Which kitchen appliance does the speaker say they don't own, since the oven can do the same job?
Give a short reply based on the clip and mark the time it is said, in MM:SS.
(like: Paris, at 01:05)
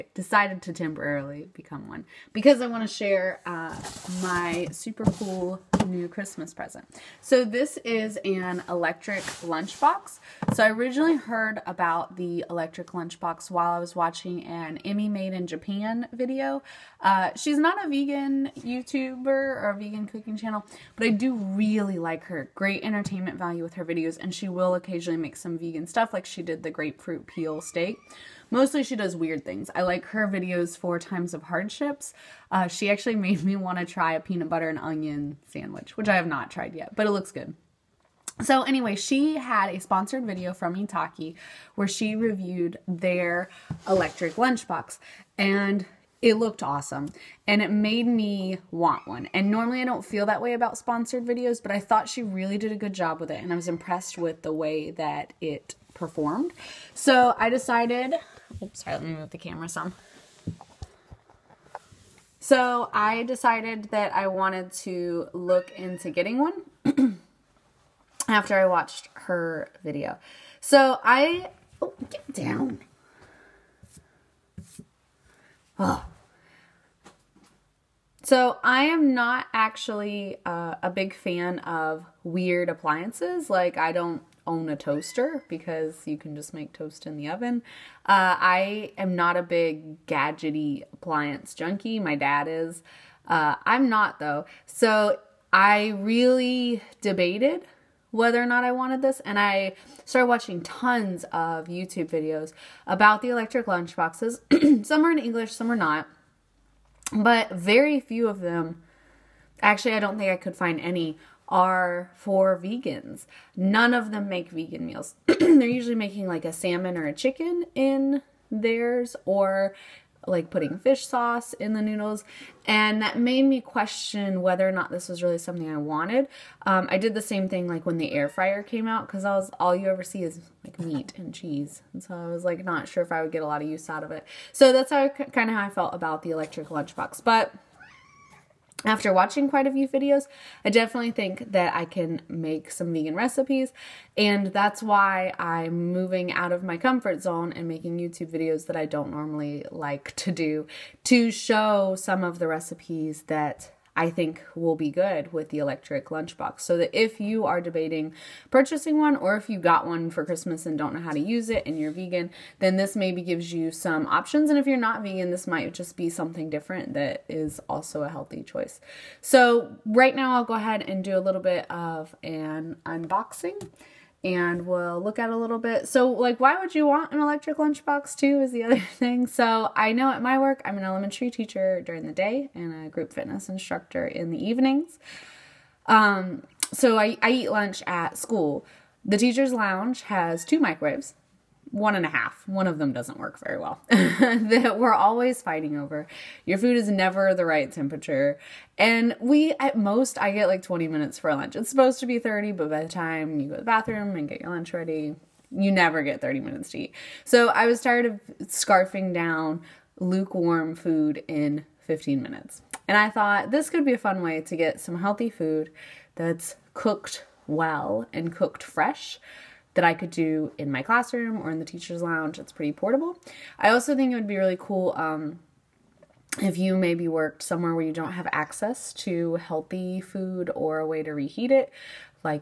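toaster, at 01:24.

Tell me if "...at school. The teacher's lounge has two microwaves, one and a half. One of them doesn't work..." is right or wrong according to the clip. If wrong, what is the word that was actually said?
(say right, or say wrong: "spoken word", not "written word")
right.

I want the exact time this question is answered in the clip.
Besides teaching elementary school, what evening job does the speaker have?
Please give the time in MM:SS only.
03:02.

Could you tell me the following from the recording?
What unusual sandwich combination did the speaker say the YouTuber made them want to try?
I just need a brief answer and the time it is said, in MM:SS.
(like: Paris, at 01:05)
peanut butter and onion, at 00:34.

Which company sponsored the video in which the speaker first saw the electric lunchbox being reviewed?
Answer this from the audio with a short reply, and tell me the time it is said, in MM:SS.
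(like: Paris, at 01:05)
Itaki, at 00:40.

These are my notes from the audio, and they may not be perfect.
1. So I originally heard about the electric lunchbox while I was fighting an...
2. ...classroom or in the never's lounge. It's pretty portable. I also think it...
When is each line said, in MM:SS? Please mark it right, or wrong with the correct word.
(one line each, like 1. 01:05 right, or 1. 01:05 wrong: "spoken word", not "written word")
1. 00:10 wrong: "watching", not "fighting"
2. 03:40 wrong: "teacher", not "never".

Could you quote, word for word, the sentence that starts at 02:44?
And if you're not vegan, this might just be something different that is also a healthy choice.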